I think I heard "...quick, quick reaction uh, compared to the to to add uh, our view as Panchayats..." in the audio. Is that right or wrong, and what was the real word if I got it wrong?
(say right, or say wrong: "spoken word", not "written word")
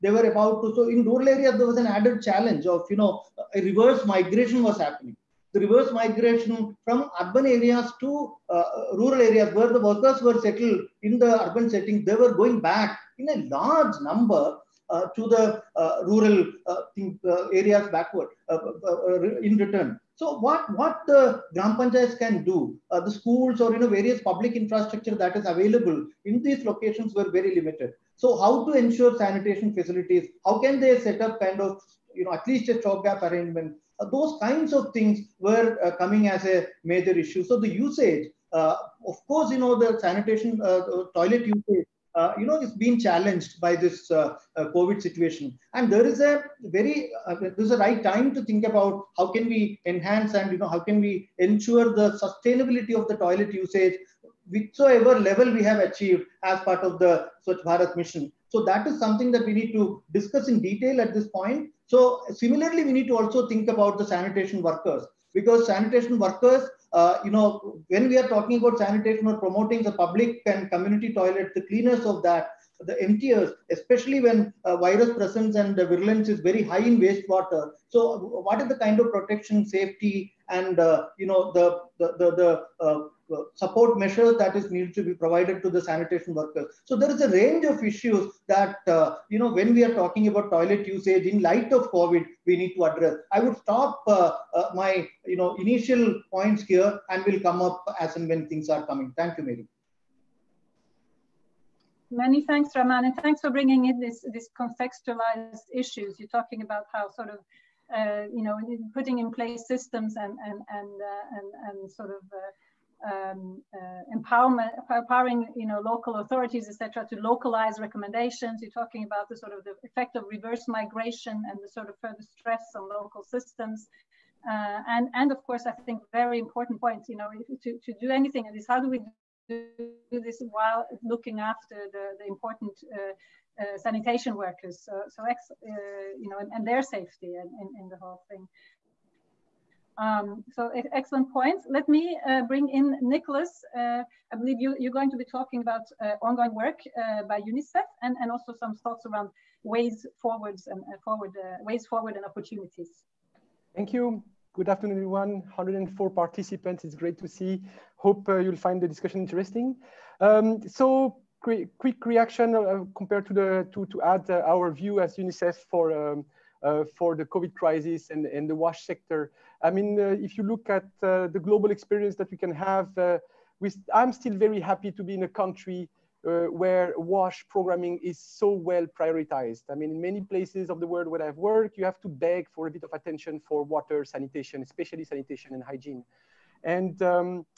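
wrong: "UNICEF", not "Panchayats".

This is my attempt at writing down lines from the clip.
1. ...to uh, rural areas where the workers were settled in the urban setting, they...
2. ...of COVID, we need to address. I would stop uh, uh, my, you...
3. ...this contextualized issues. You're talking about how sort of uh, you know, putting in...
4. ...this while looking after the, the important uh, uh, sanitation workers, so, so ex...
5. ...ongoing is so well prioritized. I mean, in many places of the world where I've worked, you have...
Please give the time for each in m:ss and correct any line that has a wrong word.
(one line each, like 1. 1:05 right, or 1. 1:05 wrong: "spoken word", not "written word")
1. 0:07 right
2. 1:31 right
3. 1:44 right
4. 2:10 right
5. 2:57 wrong: "programming", not "ongoing".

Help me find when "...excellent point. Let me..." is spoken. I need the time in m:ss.
2:20.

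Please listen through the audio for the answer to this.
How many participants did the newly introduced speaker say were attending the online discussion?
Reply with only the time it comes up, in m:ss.
2:35.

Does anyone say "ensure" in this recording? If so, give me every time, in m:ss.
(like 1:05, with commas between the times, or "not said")
0:28, 0:51.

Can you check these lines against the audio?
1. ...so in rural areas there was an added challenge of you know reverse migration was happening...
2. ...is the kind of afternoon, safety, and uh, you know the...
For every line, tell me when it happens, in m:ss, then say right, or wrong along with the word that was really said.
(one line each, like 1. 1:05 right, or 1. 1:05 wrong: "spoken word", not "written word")
1. 0:00 right
2. 1:18 wrong: "protection", not "afternoon".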